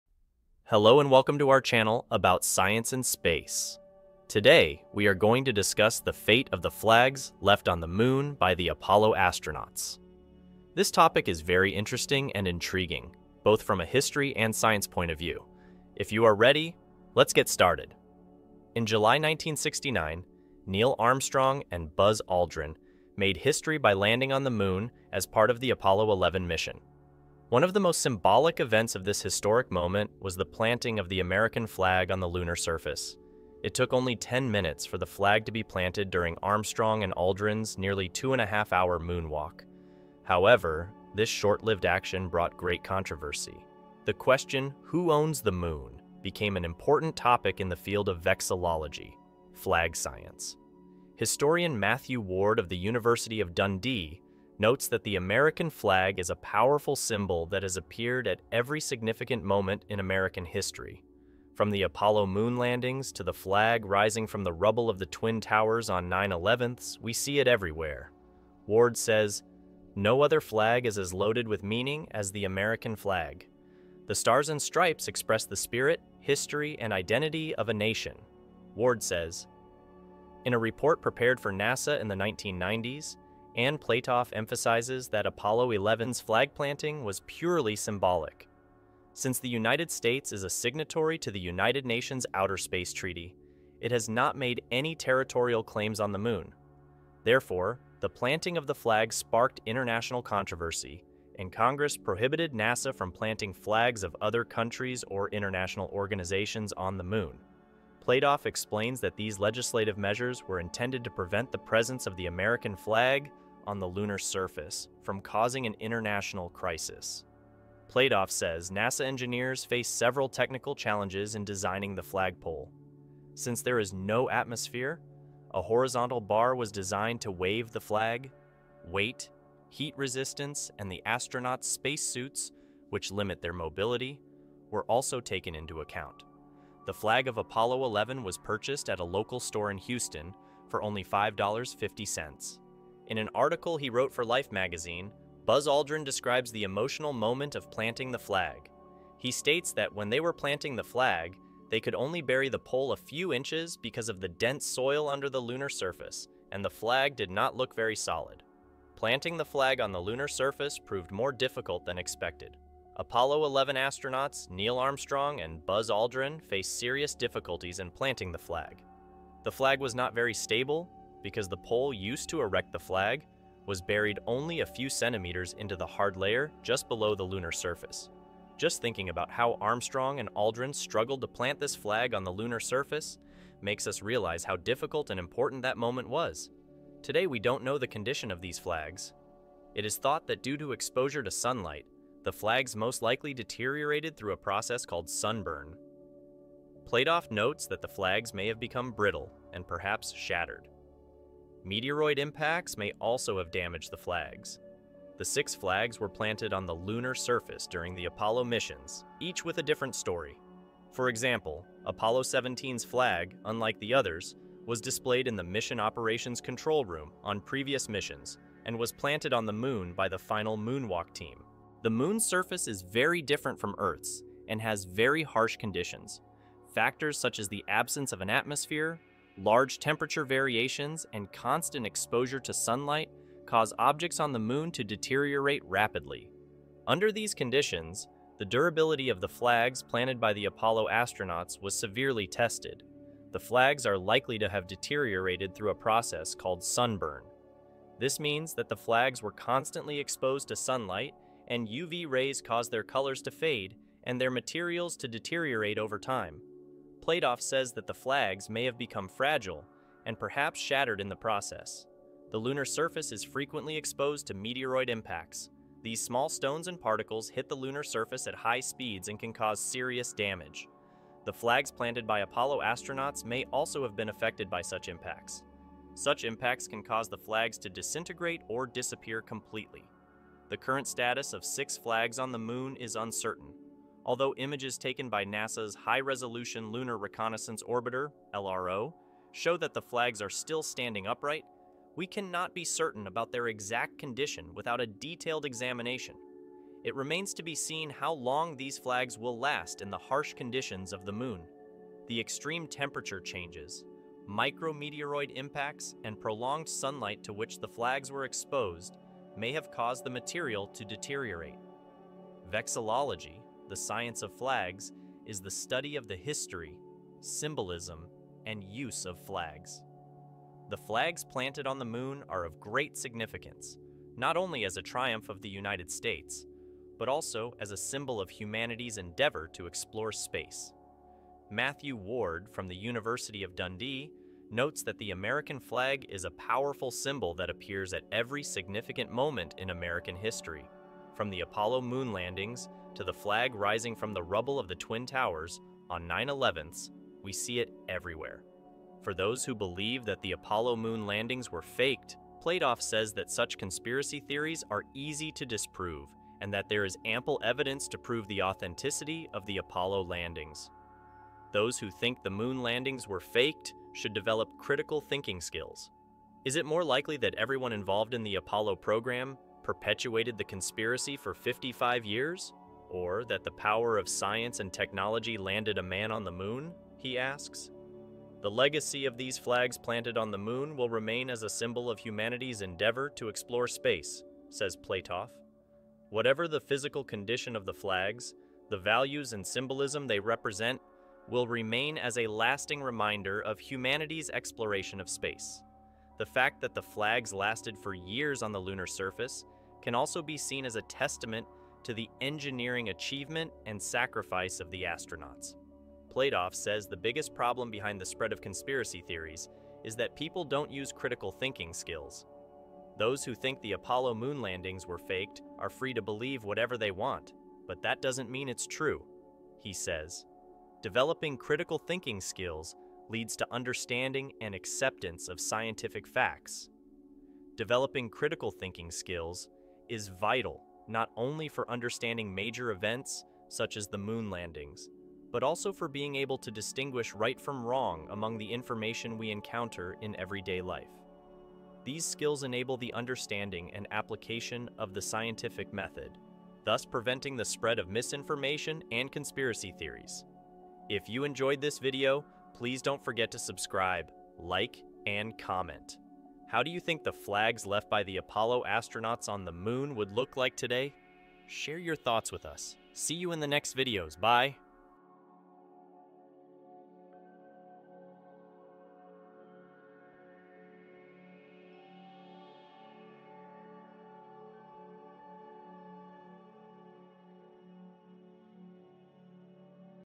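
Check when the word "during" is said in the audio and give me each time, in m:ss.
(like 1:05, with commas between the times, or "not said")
0:36, 3:27.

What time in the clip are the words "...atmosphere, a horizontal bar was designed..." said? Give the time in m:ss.
2:04.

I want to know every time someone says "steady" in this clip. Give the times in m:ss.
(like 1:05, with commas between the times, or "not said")
not said.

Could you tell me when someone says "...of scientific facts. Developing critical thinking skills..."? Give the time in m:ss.
7:05.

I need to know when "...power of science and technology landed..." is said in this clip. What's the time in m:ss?
6:13.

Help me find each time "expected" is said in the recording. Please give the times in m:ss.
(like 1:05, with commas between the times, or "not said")
2:41.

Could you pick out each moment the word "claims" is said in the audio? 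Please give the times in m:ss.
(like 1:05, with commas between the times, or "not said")
1:35.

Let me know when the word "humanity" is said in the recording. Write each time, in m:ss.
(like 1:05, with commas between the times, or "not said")
5:28, 6:21, 6:33.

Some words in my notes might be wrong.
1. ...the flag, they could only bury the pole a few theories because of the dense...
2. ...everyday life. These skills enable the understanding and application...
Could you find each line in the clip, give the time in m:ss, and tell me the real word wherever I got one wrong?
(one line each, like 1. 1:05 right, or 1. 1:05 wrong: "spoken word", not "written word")
1. 2:30 wrong: "inches", not "theories"
2. 7:20 right.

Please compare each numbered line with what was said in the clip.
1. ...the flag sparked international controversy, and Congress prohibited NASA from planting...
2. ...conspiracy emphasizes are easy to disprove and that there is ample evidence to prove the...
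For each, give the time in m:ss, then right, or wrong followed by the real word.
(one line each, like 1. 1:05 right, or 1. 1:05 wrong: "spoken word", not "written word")
1. 1:38 right
2. 5:53 wrong: "theories", not "emphasizes".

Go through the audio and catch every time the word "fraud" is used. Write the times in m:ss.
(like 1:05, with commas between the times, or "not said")
not said.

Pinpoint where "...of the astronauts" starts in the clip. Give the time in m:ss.
6:44.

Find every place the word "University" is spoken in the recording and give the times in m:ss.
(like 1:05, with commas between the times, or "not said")
0:52, 5:32.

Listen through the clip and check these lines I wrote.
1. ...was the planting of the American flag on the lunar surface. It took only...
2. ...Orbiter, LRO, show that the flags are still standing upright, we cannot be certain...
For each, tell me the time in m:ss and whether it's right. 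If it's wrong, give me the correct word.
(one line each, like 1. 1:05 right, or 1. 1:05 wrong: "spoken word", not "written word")
1. 0:30 right
2. 4:47 right.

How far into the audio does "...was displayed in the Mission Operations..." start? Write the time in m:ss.
3:34.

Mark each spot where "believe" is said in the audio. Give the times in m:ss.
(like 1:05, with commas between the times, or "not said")
5:49, 6:56.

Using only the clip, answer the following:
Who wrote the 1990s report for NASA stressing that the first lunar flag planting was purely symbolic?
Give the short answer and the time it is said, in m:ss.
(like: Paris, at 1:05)
Anne Platoff, at 1:23.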